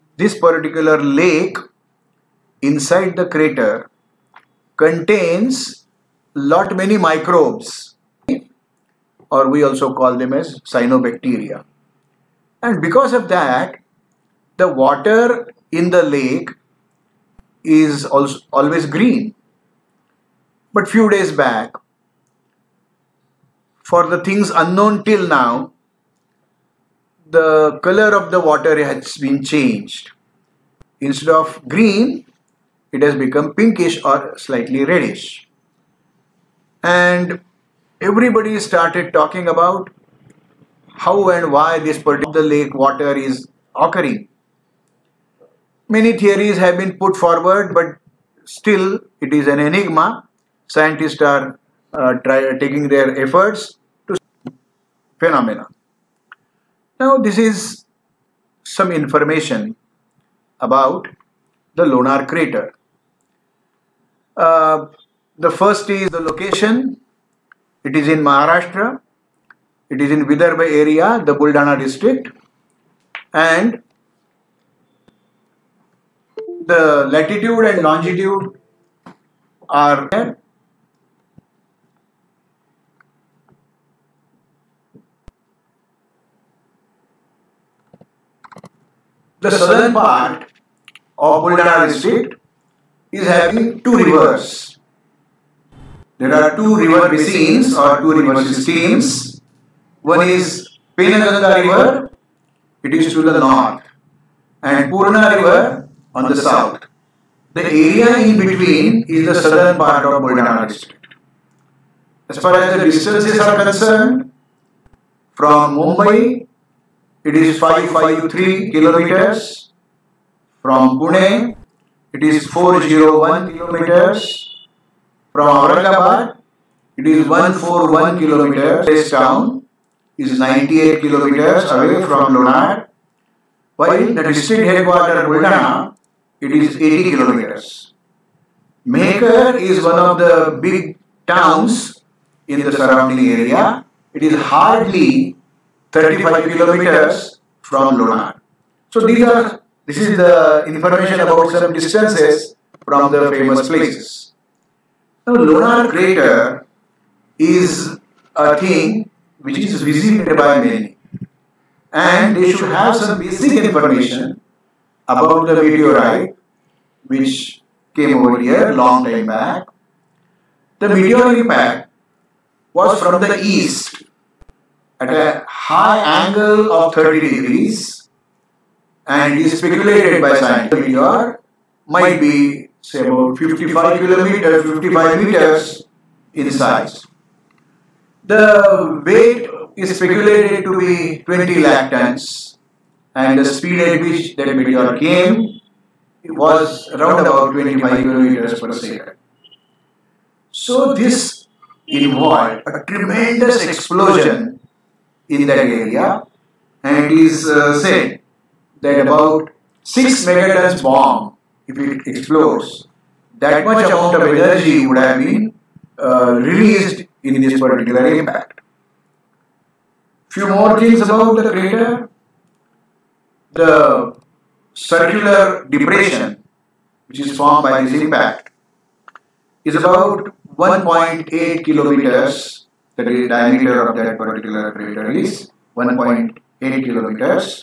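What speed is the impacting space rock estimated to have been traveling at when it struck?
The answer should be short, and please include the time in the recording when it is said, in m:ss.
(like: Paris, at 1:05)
25 kilometers per second, at 3:17.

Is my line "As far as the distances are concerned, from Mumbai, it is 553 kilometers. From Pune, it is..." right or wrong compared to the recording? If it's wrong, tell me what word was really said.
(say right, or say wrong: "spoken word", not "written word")
right.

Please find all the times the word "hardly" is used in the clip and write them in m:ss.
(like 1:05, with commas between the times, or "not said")
2:24.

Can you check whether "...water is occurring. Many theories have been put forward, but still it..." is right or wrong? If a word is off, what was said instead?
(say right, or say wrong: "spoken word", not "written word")
right.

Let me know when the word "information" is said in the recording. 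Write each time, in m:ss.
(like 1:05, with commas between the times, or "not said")
0:58, 2:30, 2:43.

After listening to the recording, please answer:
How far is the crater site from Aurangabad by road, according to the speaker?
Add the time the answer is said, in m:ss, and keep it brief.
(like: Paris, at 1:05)
141 kilometers, at 2:07.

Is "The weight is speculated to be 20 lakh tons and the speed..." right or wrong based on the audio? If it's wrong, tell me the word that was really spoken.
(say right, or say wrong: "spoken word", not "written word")
right.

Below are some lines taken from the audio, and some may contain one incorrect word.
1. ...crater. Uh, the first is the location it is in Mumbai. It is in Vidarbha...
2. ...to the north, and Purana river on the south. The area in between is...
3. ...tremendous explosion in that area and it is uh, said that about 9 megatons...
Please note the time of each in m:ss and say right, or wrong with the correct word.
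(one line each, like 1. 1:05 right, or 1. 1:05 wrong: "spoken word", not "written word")
1. 1:02 wrong: "Maharashtra", not "Mumbai"
2. 1:43 right
3. 3:22 wrong: "6", not "9".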